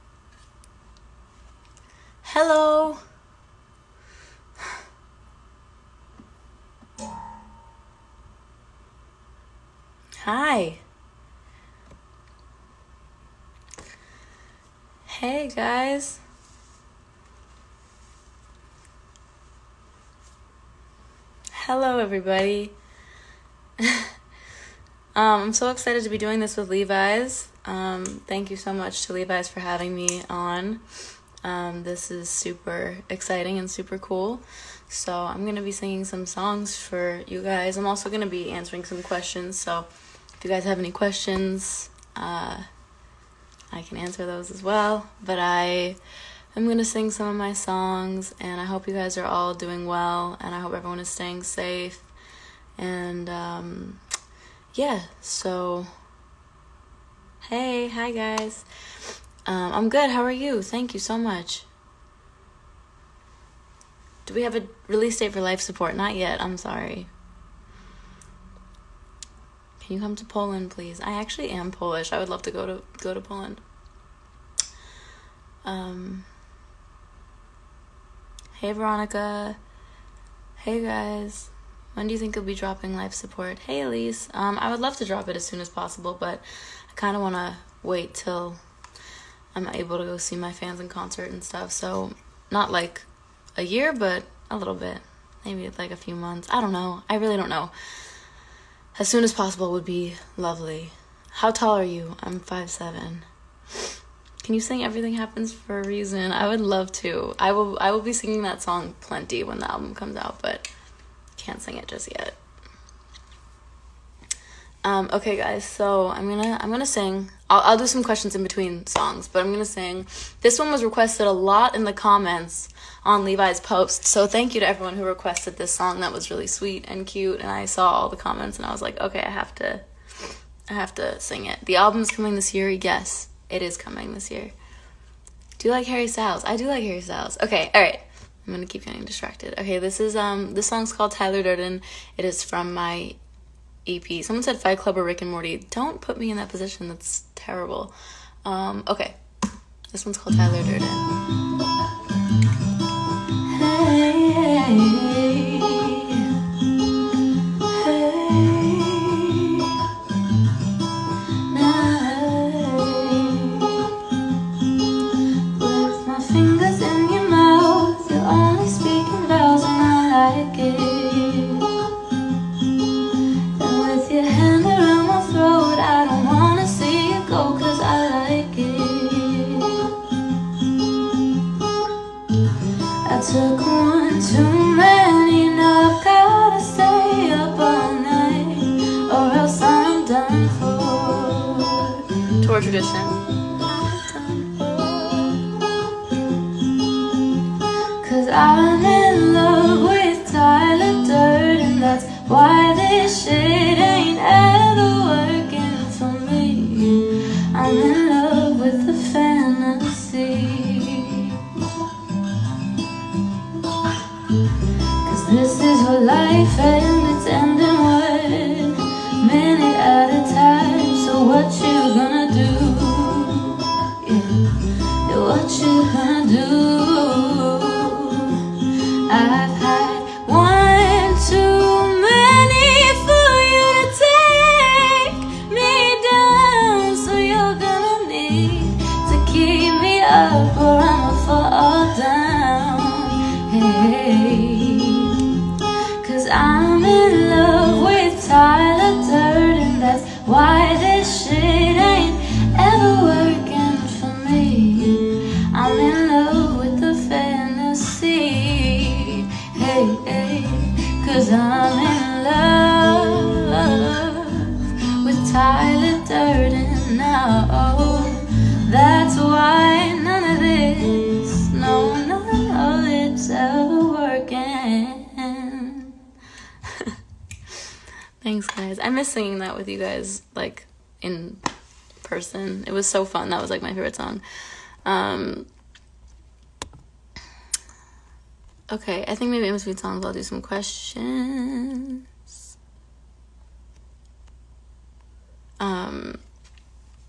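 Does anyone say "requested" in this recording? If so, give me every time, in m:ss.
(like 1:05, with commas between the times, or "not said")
2:00, 2:05.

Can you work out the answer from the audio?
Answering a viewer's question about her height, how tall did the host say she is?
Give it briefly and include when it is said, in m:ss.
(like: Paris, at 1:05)
5'7", at 1:42.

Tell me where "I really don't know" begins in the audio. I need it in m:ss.
1:37.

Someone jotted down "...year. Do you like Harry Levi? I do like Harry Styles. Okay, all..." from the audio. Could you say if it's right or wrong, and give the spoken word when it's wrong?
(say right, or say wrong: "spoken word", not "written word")
wrong: "Styles", not "Levi".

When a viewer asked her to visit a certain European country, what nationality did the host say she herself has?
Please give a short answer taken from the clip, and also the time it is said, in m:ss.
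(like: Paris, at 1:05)
Polish, at 1:11.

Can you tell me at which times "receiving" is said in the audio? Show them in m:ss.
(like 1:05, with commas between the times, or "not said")
not said.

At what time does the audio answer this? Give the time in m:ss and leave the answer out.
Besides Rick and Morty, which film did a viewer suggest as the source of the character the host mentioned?
2:24.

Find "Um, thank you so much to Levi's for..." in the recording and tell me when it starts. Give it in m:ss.
0:27.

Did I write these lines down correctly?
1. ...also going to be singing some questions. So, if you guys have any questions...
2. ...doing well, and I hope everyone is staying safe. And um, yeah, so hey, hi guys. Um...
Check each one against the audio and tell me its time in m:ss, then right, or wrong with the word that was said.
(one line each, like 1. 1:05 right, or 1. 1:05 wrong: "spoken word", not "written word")
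1. 0:37 wrong: "answering", not "singing"
2. 0:49 right.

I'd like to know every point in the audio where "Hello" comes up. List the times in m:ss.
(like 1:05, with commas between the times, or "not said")
0:02, 0:21.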